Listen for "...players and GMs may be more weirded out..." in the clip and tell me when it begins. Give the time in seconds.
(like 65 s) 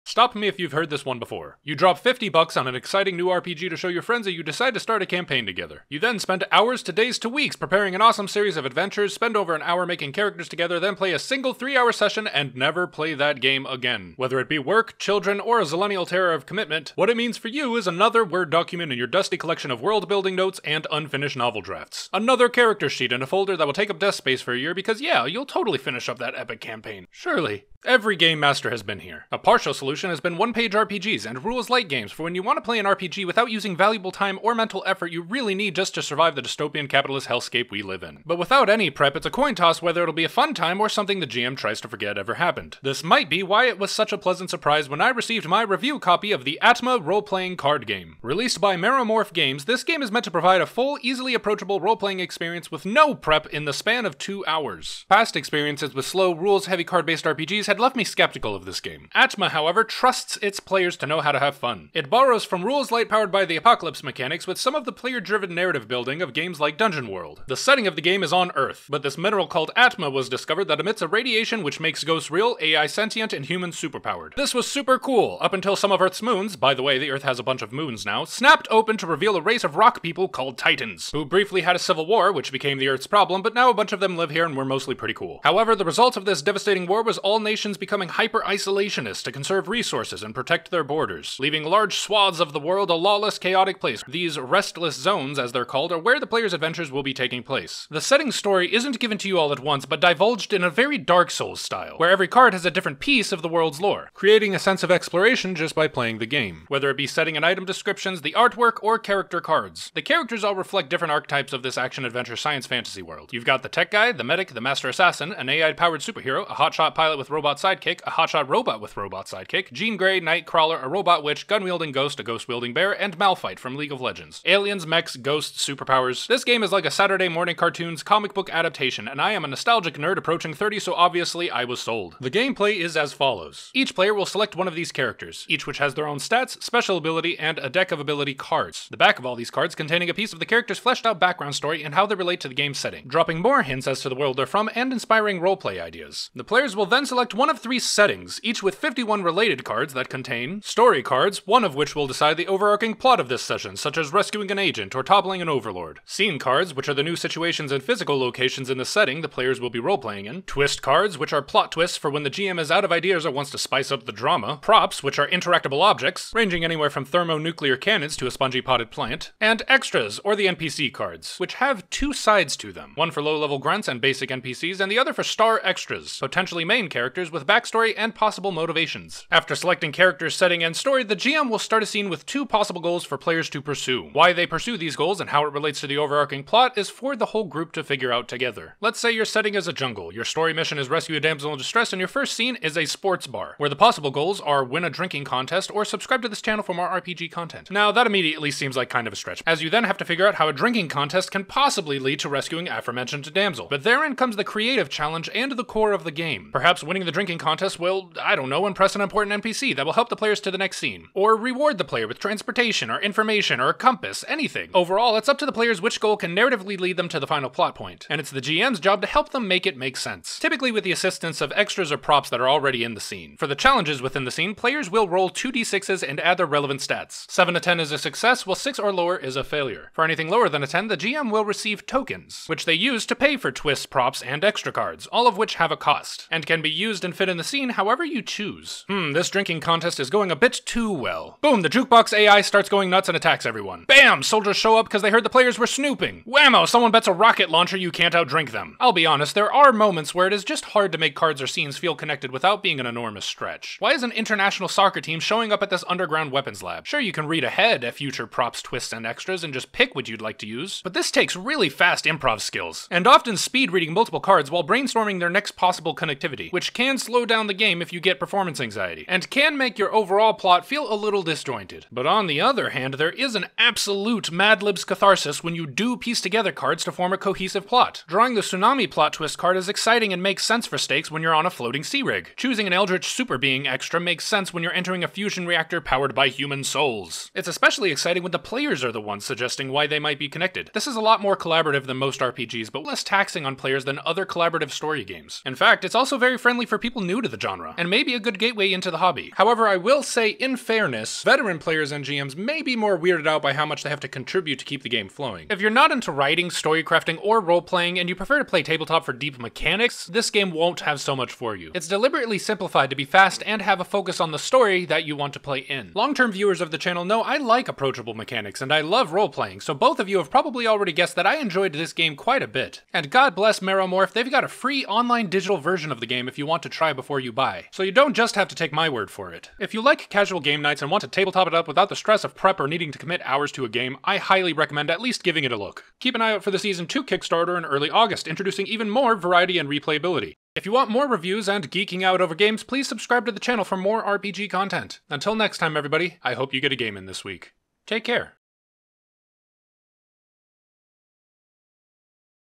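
301 s.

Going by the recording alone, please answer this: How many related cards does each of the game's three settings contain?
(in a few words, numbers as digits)
51.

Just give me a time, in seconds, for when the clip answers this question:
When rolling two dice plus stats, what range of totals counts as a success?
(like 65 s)
227 s.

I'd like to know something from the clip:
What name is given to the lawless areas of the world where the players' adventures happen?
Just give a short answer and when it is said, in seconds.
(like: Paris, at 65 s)
restless zones, at 94 s.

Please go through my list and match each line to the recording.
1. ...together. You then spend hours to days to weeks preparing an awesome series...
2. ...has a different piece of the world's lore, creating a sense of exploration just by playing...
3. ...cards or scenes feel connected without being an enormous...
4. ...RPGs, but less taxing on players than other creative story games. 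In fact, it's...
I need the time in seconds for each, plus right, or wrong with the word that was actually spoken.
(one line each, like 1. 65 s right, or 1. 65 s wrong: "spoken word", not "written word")
1. 5 s right
2. 102 s right
3. 251 s right
4. 292 s wrong: "collaborative", not "creative".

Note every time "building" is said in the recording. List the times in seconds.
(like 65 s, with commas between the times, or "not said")
19 s, 65 s.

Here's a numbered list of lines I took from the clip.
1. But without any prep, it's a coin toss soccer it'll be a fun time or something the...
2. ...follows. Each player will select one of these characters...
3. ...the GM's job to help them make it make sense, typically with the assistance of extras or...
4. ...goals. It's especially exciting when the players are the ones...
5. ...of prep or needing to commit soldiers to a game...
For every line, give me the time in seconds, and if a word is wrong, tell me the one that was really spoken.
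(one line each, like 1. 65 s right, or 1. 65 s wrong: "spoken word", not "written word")
1. 38 s wrong: "whether", not "soccer"
2. 133 s right
3. 218 s right
4. 286 s wrong: "souls", not "goals"
5. 332 s wrong: "hours", not "soldiers".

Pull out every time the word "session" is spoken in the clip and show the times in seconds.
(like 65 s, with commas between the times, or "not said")
11 s, 153 s.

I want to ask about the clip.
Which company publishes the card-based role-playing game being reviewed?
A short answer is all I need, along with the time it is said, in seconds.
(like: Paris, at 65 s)
Meromorph Games, at 48 s.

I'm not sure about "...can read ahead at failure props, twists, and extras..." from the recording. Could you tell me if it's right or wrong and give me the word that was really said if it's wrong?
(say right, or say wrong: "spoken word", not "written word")
wrong: "future", not "failure".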